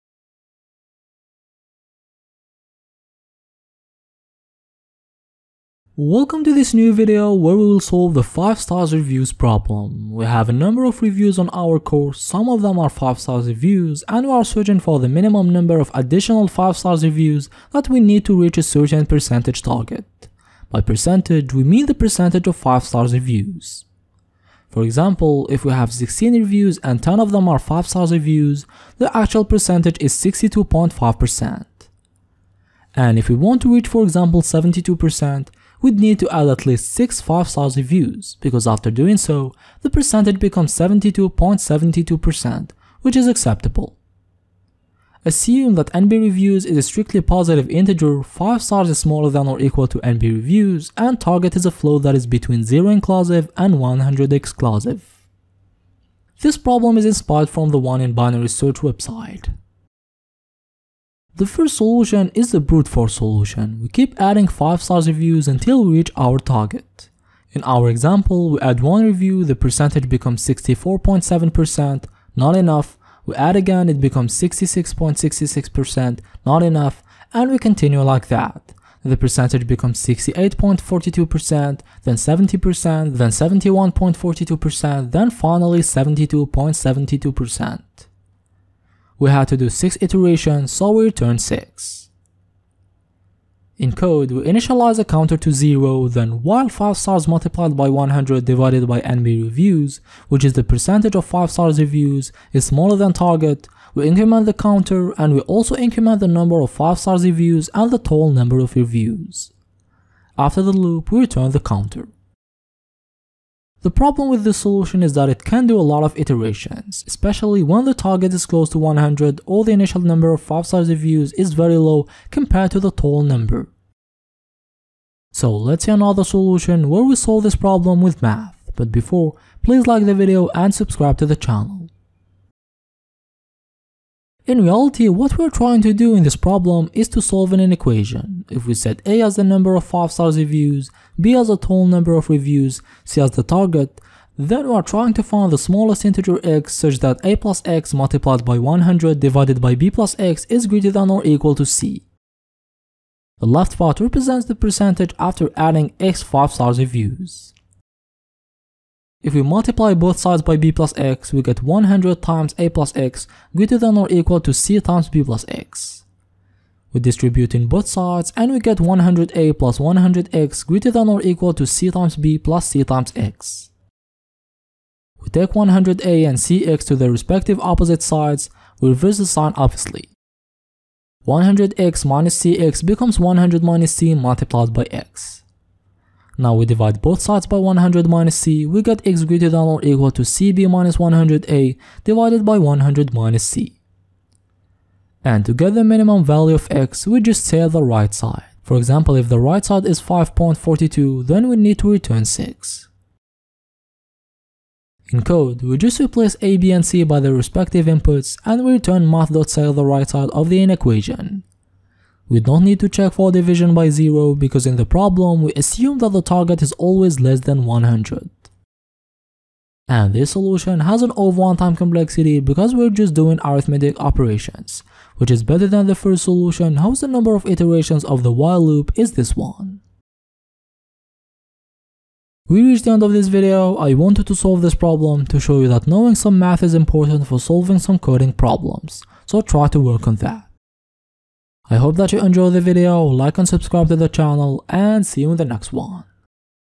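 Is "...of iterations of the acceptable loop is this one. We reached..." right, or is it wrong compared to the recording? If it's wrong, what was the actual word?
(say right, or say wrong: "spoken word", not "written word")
wrong: "while", not "acceptable".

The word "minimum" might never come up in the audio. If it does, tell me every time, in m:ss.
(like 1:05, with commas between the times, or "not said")
0:15, 3:15.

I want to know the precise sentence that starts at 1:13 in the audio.
We add again, it becomes 66.66%, not enough, and we continue like that.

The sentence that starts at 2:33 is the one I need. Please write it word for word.
The left part represents the percentage after adding x 5 stars reviews.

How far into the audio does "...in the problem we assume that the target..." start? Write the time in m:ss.
3:34.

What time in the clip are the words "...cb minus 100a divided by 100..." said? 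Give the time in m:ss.
3:10.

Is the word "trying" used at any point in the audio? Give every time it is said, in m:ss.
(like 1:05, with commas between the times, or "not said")
2:15, 2:24.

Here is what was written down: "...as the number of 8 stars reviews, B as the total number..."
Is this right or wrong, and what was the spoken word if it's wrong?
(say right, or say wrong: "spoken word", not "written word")
wrong: "5", not "8".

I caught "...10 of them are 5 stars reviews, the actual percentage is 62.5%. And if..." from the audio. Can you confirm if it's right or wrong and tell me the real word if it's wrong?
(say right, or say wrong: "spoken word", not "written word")
right.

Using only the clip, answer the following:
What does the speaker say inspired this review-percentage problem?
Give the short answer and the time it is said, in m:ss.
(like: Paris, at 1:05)
binary search, at 0:58.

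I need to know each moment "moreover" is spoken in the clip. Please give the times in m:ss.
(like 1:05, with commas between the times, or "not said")
not said.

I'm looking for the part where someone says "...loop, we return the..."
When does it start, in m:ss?
1:50.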